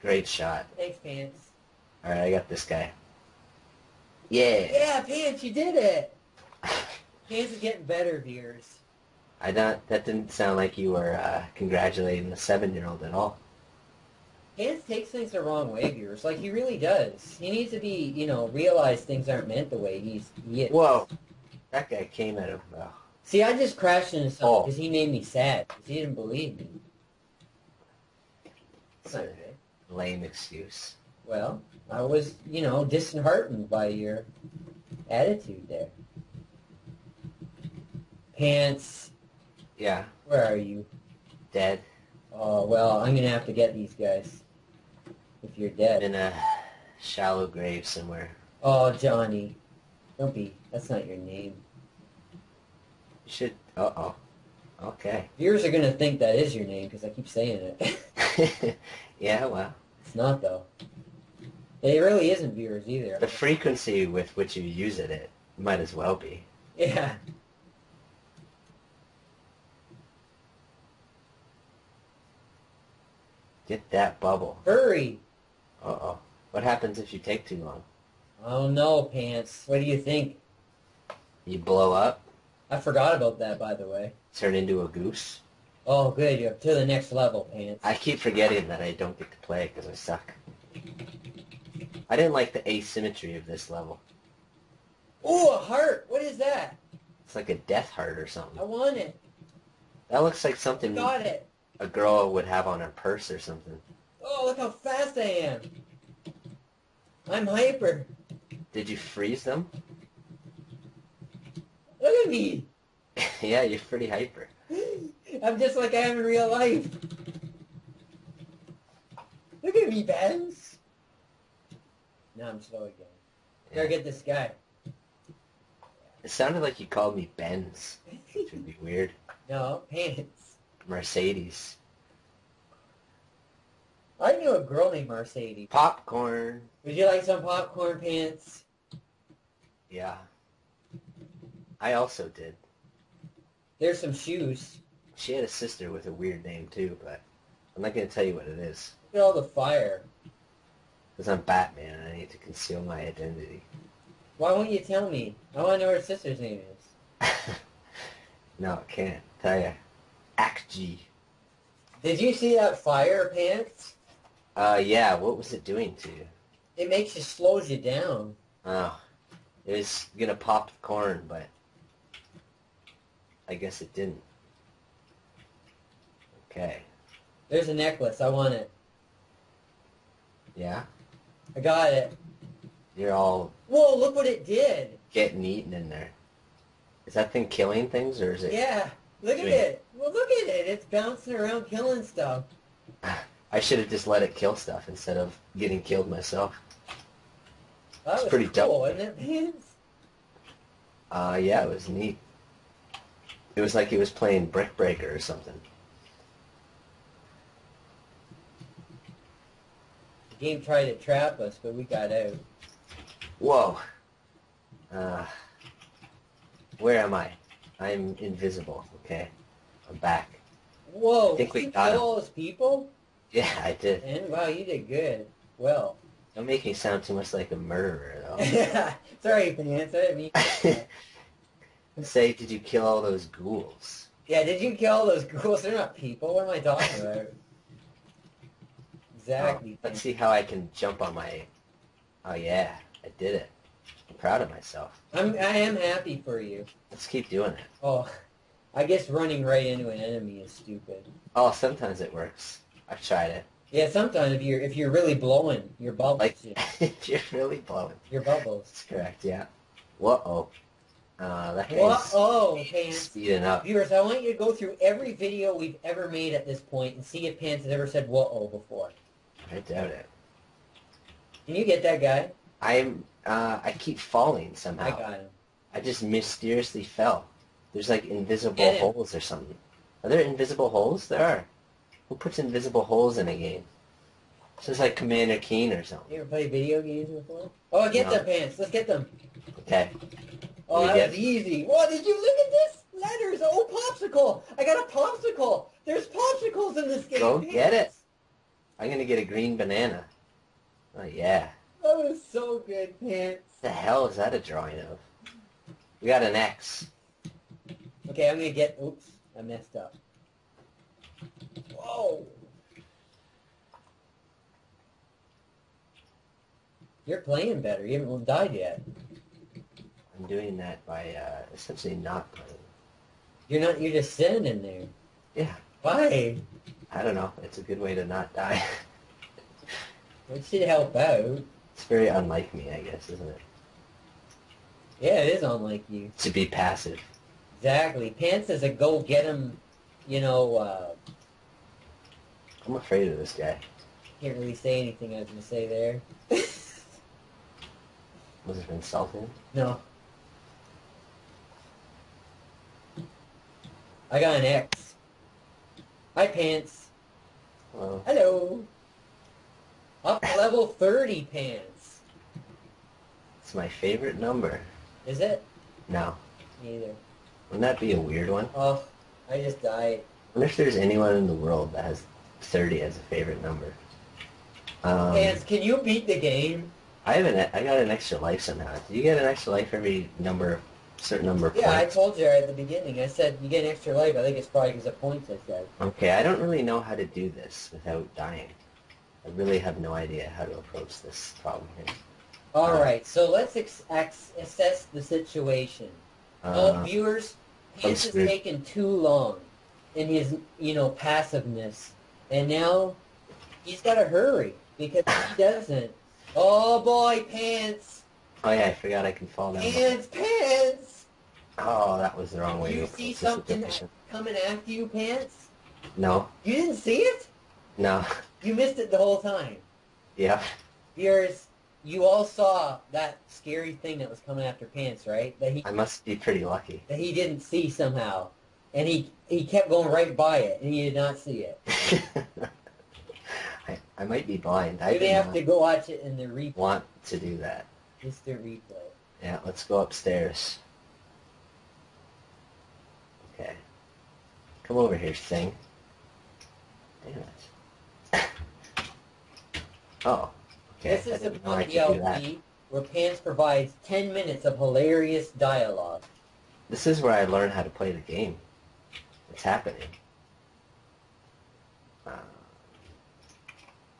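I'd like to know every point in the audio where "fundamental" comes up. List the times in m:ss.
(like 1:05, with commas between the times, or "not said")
not said.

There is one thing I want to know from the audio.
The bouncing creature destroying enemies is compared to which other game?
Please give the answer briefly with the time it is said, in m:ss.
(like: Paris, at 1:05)
Brick Breaker, at 3:24.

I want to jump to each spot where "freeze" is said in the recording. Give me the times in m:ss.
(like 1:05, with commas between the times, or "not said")
1:48.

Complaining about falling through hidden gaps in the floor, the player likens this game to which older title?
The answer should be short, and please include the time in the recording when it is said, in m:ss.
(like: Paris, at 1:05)
Commander Keen, at 4:44.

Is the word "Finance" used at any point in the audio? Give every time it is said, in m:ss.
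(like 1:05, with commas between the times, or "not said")
3:49.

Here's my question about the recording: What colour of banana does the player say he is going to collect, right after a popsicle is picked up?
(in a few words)
green.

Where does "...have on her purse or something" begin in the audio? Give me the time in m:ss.
1:42.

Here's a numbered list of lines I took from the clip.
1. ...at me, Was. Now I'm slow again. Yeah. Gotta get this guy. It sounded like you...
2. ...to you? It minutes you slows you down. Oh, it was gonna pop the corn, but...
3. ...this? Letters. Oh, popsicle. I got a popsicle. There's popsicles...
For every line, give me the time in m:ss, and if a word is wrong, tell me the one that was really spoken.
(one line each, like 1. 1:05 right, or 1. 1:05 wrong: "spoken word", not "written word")
1. 1:59 wrong: "Benz", not "Was"
2. 2:45 wrong: "makes", not "minutes"
3. 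4:52 right.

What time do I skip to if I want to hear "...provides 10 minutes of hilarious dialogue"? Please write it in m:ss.
7:33.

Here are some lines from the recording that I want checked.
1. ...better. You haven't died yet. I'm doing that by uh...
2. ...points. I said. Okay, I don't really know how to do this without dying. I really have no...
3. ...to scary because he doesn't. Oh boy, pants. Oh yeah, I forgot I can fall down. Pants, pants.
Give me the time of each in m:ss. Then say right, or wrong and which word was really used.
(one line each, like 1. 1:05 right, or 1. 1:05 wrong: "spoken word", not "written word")
1. 5:17 right
2. 6:25 right
3. 6:43 wrong: "hurry", not "scary".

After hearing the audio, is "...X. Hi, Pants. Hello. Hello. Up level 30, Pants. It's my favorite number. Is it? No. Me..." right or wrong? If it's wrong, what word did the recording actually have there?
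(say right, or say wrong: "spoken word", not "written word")
right.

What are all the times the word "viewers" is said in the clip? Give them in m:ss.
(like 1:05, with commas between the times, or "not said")
0:08, 0:15, 0:55, 1:02, 4:23, 6:36.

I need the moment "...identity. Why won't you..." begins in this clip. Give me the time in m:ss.
2:33.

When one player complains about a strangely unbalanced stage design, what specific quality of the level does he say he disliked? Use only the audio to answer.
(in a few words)
asymmetry.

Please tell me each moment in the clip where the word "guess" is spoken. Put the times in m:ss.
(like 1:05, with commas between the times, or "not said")
2:53, 4:08, 5:32.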